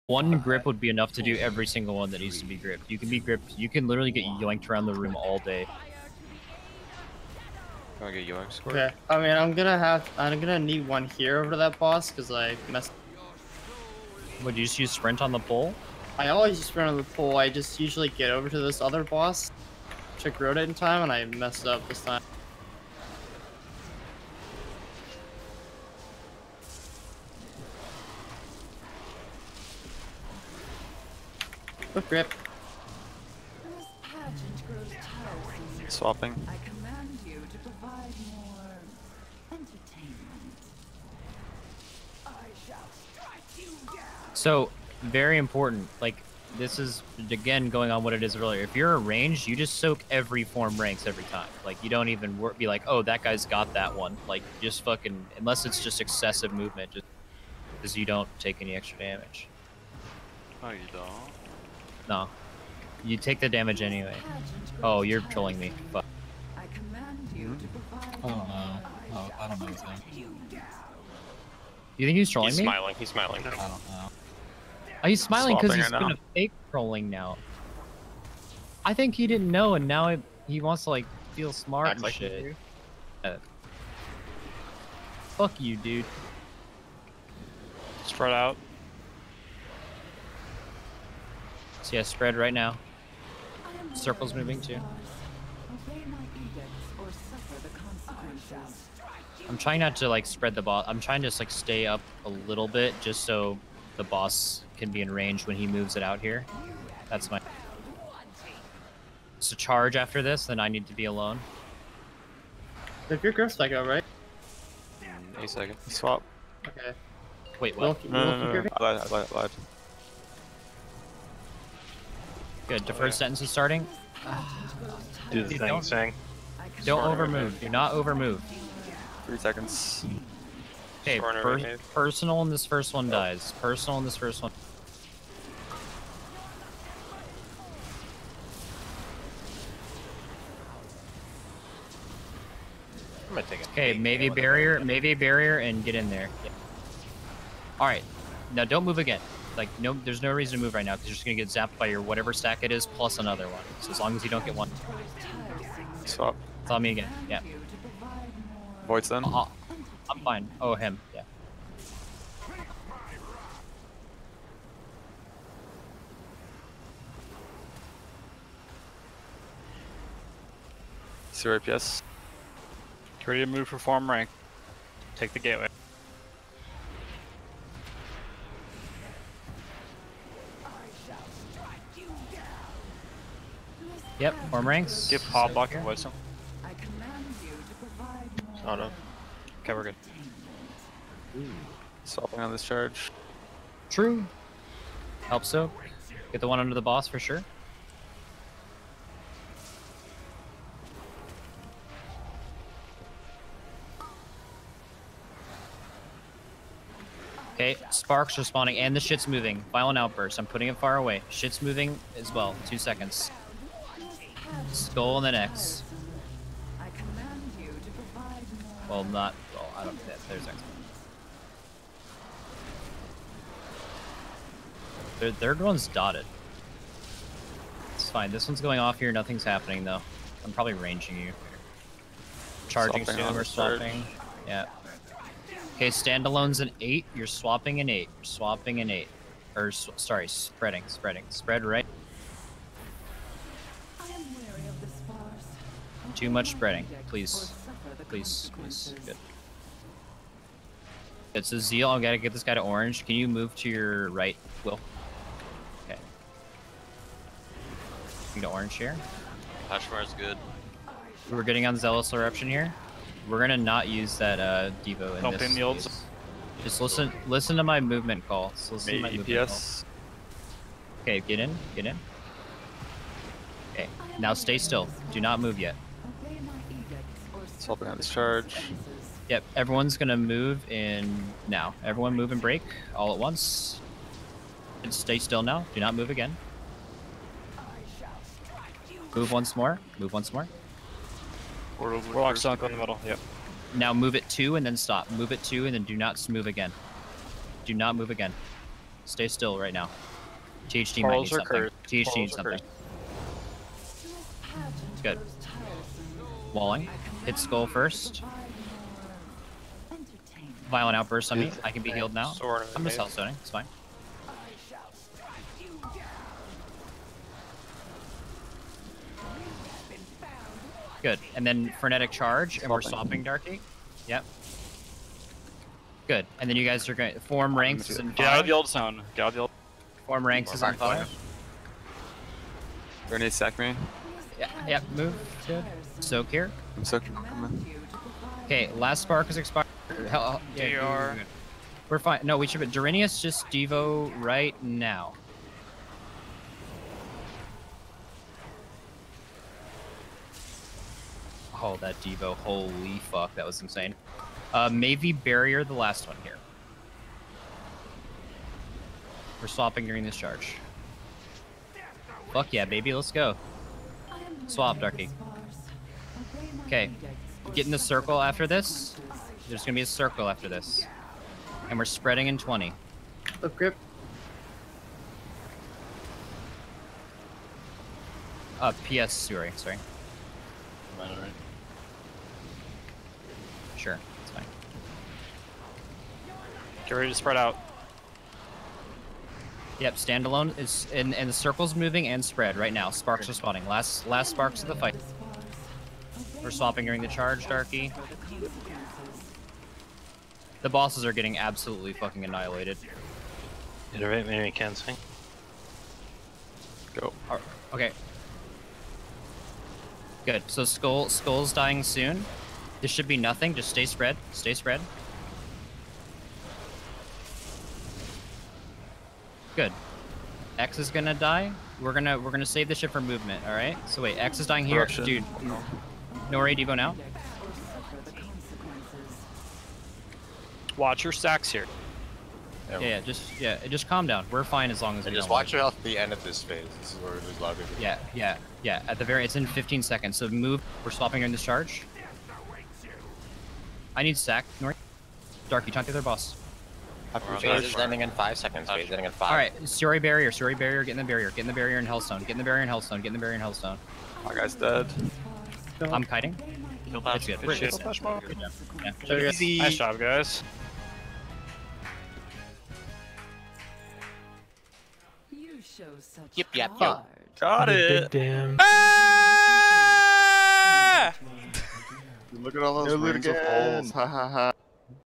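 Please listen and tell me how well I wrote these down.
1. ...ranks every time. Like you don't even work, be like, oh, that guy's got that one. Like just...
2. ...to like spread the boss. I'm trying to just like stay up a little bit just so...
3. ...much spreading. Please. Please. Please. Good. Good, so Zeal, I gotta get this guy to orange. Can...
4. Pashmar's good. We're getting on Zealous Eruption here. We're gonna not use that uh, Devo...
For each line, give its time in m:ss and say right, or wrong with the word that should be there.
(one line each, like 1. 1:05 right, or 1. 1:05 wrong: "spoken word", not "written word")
1. 0:50 right
2. 1:39 right
3. 4:06 right
4. 4:19 right.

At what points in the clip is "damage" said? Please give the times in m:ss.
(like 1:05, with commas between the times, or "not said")
0:58, 1:03.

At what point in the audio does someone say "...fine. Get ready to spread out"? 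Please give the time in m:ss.
6:24.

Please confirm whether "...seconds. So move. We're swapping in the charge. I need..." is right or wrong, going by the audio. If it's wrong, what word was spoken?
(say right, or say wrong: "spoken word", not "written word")
right.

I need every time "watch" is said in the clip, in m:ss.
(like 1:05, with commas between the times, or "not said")
7:10, 7:15.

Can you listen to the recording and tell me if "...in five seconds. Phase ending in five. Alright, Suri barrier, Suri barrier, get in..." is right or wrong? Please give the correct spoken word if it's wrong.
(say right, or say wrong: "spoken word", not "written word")
right.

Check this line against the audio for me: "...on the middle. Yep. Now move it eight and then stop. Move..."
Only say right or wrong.
wrong.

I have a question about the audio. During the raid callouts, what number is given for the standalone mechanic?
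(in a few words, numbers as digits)
8.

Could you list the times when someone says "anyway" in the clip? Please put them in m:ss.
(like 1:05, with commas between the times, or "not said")
1:03.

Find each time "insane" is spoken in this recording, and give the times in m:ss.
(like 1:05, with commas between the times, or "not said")
5:53.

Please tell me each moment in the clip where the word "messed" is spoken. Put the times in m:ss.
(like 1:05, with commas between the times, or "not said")
0:12, 0:21.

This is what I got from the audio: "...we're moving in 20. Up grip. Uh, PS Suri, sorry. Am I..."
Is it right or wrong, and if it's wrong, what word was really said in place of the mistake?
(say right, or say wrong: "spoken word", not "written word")
wrong: "spreading", not "moving".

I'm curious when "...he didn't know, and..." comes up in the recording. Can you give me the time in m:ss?
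1:19.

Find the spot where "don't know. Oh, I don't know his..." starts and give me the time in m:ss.
1:08.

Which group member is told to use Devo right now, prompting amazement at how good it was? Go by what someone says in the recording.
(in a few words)
Durinius.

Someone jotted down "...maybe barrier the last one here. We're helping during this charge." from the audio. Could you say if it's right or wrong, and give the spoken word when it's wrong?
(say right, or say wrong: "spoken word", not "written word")
wrong: "swapping", not "helping".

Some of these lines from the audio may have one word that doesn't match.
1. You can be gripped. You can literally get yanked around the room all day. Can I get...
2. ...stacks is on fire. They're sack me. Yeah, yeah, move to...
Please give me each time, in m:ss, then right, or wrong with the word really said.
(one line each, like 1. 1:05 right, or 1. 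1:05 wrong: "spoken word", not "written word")
1. 0:02 right
2. 5:30 wrong: "ranks", not "stacks".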